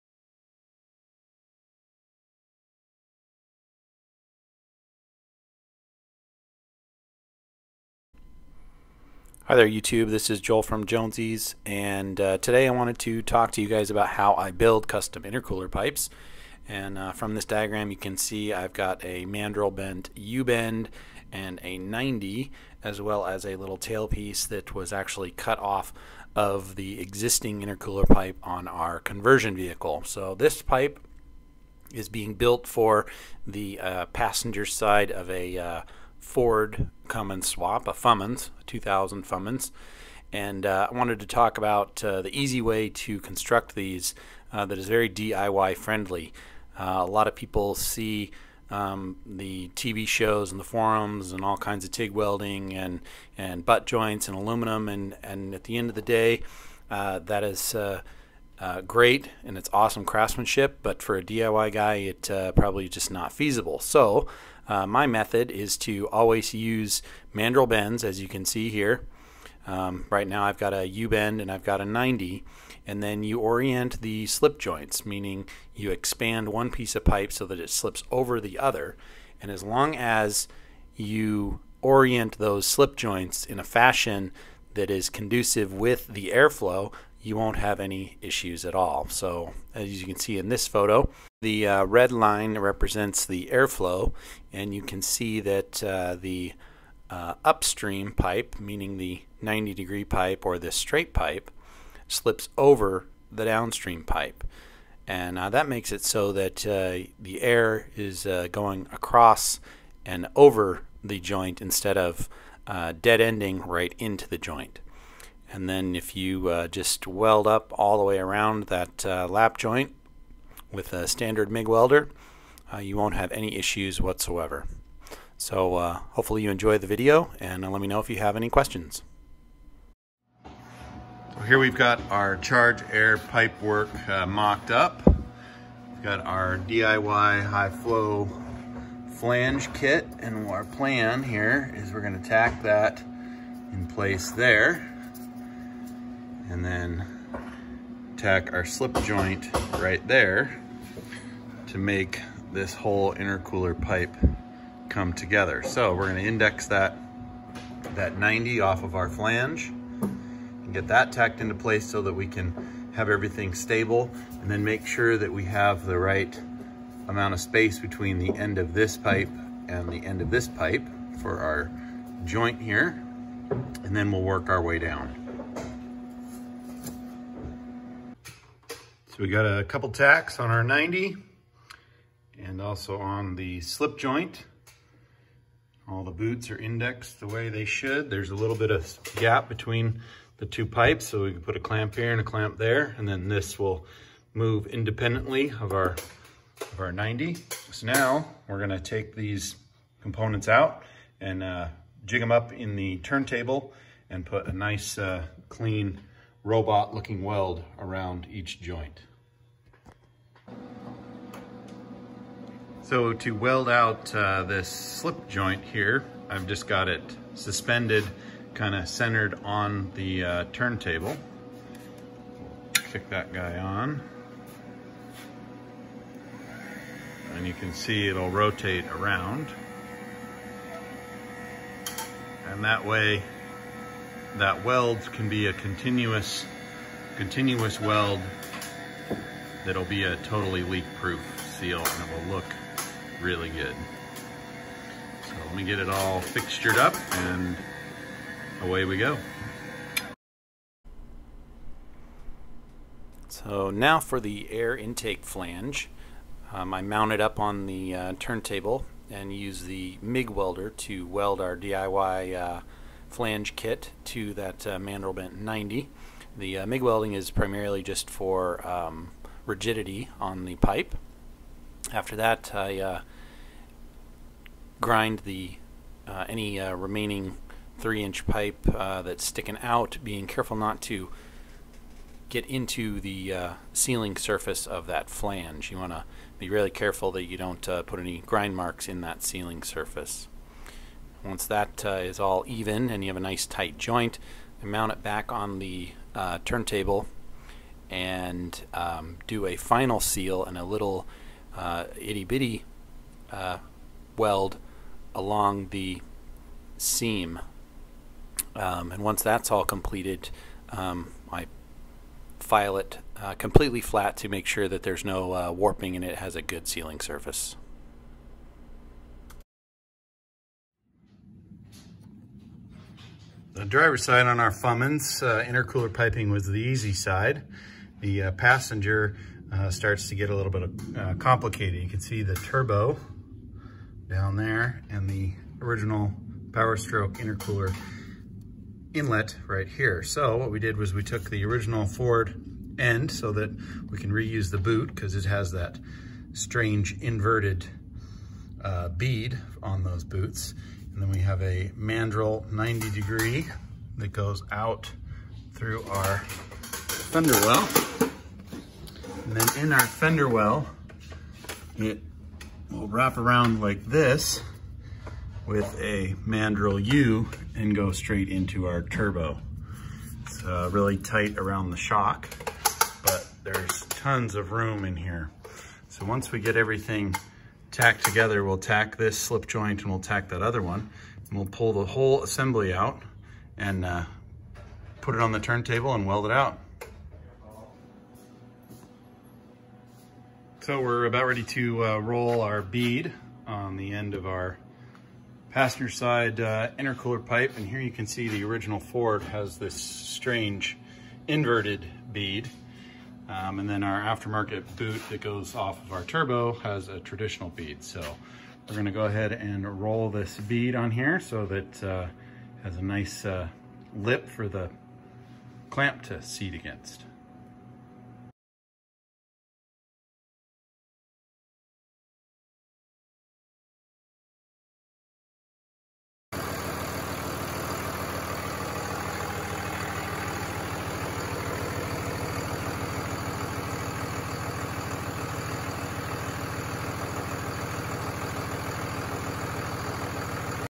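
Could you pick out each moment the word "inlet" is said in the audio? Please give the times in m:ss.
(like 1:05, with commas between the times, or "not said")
5:38.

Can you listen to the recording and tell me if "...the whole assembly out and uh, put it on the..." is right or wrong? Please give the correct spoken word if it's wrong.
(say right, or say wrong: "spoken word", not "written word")
right.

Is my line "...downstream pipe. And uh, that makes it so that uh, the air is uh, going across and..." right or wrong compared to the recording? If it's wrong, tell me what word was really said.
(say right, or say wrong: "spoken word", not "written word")
right.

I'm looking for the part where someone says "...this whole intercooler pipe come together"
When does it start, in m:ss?
2:32.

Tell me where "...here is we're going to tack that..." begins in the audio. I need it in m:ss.
2:21.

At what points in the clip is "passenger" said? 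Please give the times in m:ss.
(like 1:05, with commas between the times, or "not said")
0:34, 5:28, 6:35.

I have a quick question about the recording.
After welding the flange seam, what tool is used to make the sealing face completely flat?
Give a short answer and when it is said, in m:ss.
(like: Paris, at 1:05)
file, at 5:11.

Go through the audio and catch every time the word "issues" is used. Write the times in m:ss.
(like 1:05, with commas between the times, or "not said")
1:28, 2:03.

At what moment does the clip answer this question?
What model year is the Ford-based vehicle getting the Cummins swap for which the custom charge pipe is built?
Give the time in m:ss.
0:38.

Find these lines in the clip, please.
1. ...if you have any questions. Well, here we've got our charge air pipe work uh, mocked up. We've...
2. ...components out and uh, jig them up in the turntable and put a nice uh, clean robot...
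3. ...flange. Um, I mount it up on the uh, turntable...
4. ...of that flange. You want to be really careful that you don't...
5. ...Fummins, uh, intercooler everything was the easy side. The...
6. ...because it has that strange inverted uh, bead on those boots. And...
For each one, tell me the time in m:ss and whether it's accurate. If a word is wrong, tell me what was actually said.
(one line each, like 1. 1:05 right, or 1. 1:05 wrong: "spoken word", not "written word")
1. 2:07 right
2. 3:20 right
3. 4:15 right
4. 4:44 right
5. 5:24 wrong: "piping", not "everything"
6. 5:44 right.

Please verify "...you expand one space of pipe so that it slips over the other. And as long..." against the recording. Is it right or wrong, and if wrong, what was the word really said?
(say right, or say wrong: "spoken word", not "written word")
wrong: "piece", not "space".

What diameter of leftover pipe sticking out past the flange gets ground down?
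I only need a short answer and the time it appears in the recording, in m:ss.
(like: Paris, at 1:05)
3 inch, at 4:37.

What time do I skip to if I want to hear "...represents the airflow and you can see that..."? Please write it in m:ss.
1:32.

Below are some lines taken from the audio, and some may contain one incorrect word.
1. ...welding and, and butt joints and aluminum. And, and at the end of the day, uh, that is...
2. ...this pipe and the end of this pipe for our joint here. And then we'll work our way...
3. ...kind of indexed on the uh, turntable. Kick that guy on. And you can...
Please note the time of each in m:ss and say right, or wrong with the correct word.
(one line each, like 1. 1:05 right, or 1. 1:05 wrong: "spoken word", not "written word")
1. 0:52 right
2. 2:48 right
3. 3:38 wrong: "centered", not "indexed".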